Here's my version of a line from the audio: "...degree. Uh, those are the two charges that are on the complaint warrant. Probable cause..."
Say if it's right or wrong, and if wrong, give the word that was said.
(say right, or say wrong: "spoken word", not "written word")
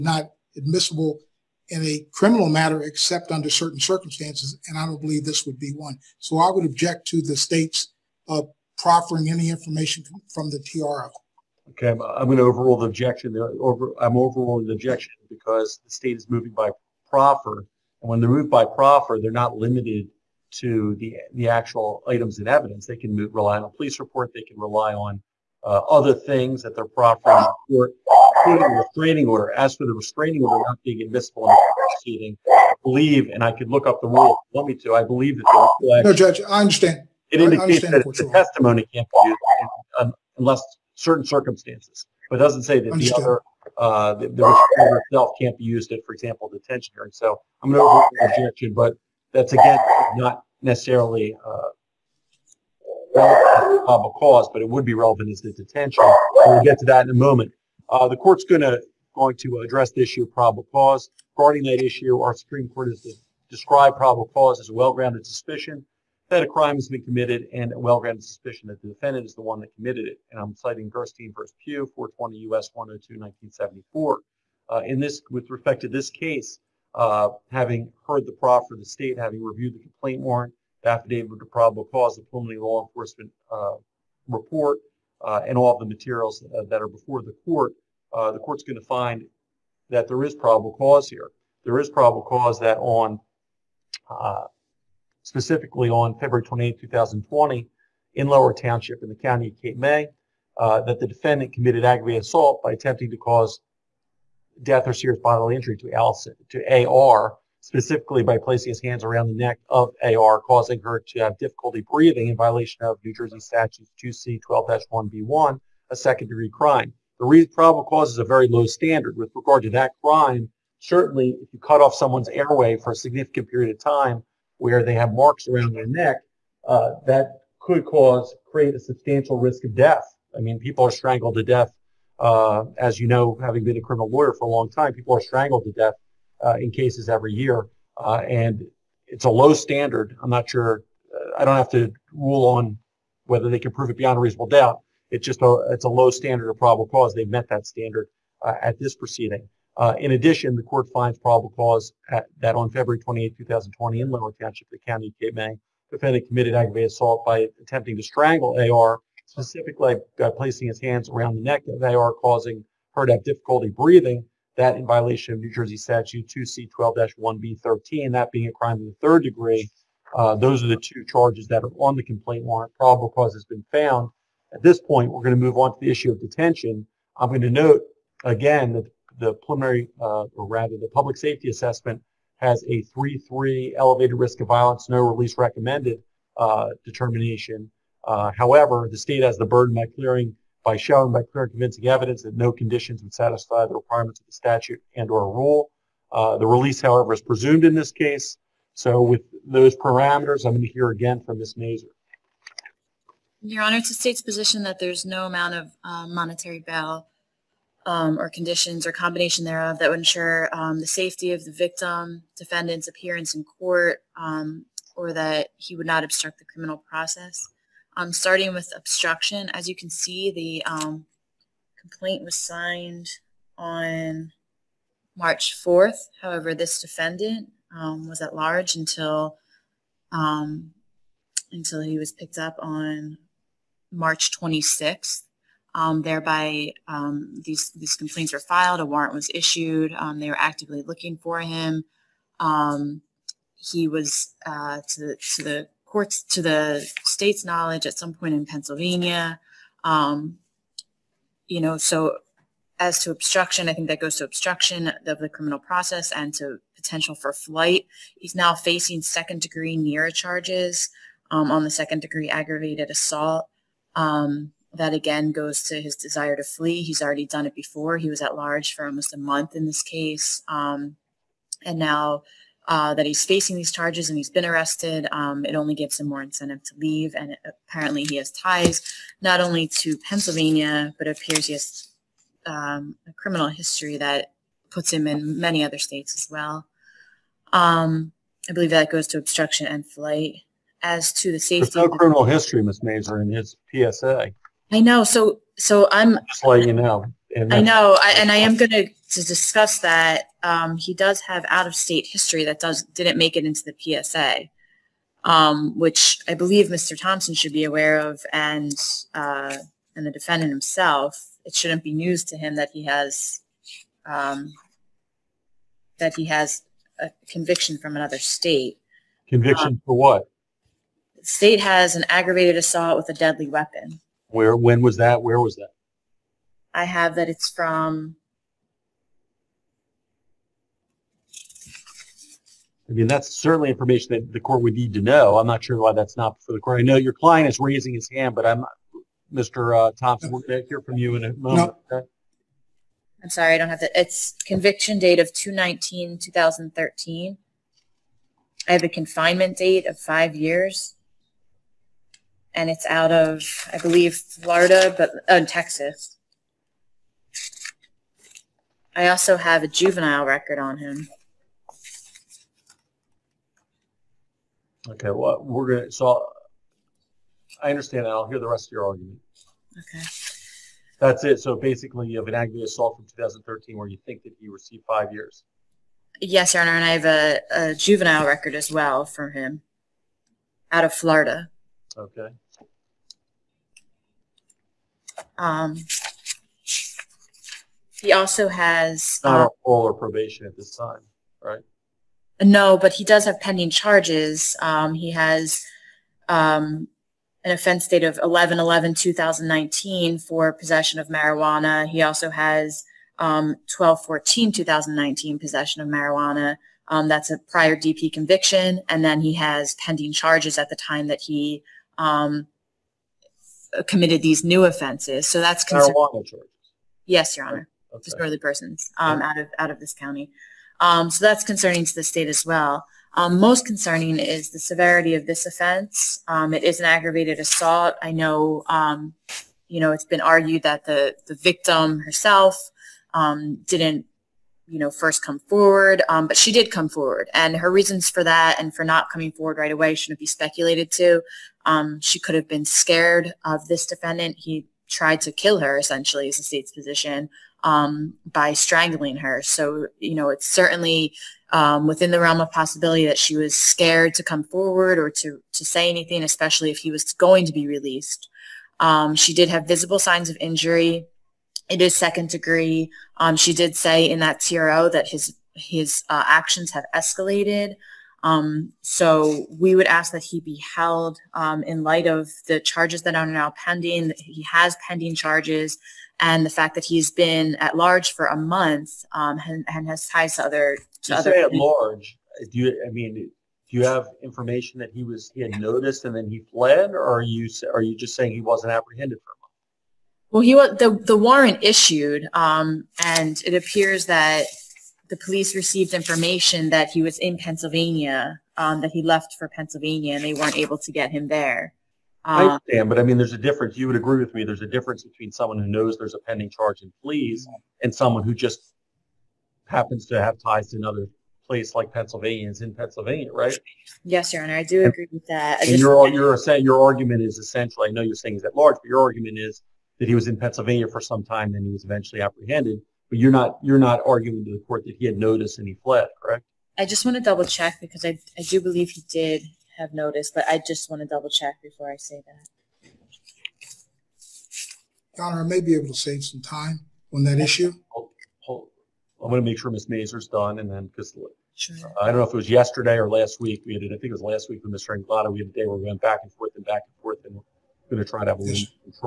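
right.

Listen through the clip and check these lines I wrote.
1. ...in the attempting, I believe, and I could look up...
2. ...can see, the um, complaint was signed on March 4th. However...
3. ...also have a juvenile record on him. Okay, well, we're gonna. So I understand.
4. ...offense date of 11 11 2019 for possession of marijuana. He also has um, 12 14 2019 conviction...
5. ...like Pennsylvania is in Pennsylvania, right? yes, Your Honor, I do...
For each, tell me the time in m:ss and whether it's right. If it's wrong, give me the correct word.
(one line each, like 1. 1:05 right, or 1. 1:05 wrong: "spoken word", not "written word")
1. 0:31 wrong: "proceeding", not "attempting"
2. 3:39 right
3. 5:59 right
4. 6:37 wrong: "possession", not "conviction"
5. 8:31 right.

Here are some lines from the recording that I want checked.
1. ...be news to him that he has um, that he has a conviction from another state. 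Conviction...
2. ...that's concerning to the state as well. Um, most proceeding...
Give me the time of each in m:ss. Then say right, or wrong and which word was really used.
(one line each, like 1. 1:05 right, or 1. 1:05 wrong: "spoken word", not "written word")
1. 5:11 right
2. 7:01 wrong: "concerning", not "proceeding".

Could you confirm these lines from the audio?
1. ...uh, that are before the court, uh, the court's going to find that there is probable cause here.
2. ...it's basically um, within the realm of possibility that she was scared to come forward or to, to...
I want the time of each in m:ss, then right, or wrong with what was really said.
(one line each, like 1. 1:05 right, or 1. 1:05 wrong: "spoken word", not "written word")
1. 1:26 right
2. 7:30 wrong: "certainly", not "basically".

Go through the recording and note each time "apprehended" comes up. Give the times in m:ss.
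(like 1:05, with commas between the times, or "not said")
8:08, 8:42.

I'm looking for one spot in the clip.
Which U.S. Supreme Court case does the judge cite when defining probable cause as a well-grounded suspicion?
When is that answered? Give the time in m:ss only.
1:10.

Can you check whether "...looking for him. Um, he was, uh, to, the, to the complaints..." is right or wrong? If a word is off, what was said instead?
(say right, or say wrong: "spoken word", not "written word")
wrong: "courts", not "complaints".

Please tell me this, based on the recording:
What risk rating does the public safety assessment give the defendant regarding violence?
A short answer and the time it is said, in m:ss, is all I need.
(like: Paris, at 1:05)
3-3, at 3:02.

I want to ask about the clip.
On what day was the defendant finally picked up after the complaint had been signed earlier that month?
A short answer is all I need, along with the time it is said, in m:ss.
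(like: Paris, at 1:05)
March 26th, at 3:53.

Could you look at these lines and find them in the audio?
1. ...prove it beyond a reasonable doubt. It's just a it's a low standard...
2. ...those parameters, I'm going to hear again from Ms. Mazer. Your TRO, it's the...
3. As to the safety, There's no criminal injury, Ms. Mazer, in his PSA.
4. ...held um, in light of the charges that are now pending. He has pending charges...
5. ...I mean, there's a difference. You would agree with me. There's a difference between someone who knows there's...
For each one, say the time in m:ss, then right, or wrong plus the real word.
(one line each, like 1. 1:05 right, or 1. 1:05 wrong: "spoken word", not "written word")
1. 2:23 right
2. 3:19 wrong: "Honor", not "TRO"
3. 4:50 wrong: "history", not "injury"
4. 7:50 right
5. 8:22 right.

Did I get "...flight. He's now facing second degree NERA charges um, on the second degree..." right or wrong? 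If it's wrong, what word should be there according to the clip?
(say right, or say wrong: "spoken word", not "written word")
right.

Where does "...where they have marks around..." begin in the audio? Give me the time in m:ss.
2:04.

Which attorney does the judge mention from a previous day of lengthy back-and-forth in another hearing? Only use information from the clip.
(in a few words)
Mr. Anglada.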